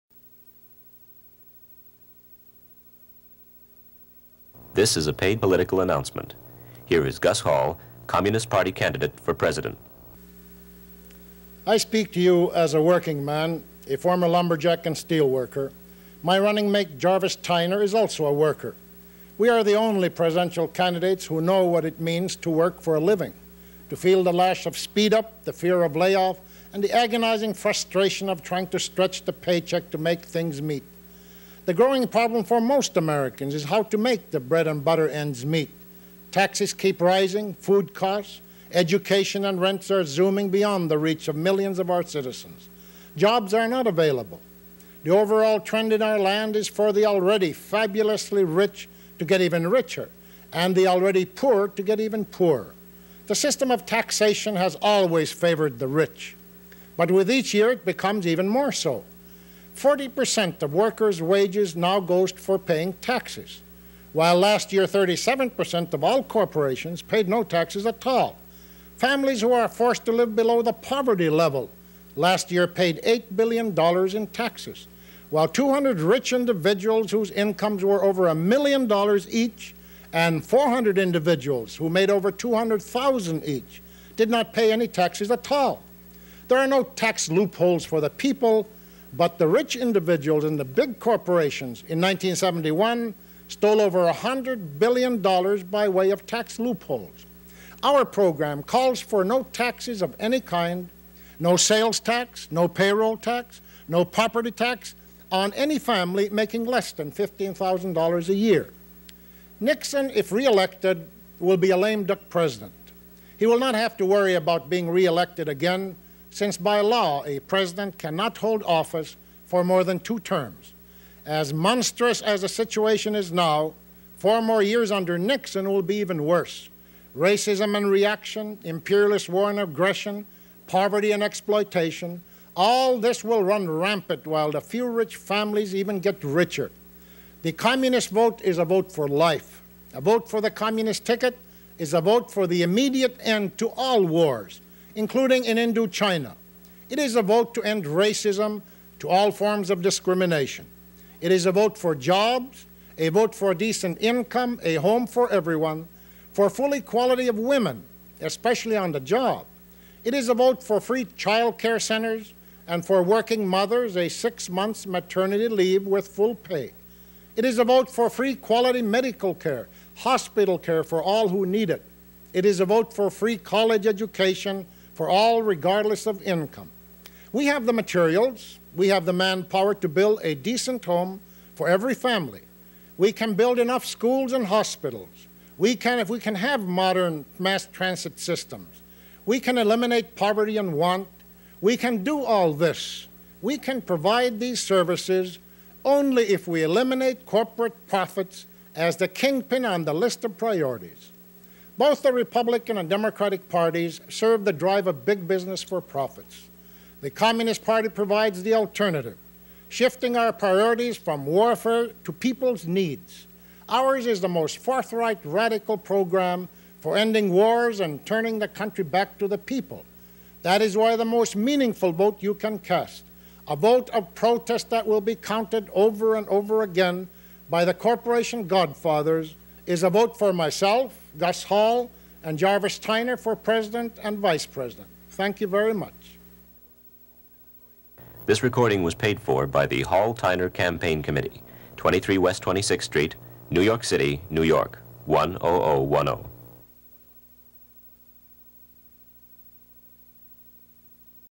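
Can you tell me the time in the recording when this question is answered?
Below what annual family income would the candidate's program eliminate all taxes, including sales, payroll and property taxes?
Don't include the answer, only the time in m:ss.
1:47.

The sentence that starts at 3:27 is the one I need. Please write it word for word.
The Communist Party provides the alternative, shifting our priorities from warfare to people's needs.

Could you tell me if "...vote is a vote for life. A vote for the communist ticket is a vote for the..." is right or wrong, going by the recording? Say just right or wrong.
right.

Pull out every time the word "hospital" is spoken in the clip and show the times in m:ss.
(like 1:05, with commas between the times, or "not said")
2:49, 3:04.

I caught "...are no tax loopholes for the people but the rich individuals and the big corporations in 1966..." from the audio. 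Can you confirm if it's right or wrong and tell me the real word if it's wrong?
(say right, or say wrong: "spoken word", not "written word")
wrong: "1971", not "1966".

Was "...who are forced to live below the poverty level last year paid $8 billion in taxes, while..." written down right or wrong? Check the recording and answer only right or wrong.
right.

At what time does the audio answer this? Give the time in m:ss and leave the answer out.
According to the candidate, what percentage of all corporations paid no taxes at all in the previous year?
1:04.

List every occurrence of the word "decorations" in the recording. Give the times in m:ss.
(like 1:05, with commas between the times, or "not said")
not said.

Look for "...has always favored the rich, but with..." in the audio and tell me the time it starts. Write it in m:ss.
0:54.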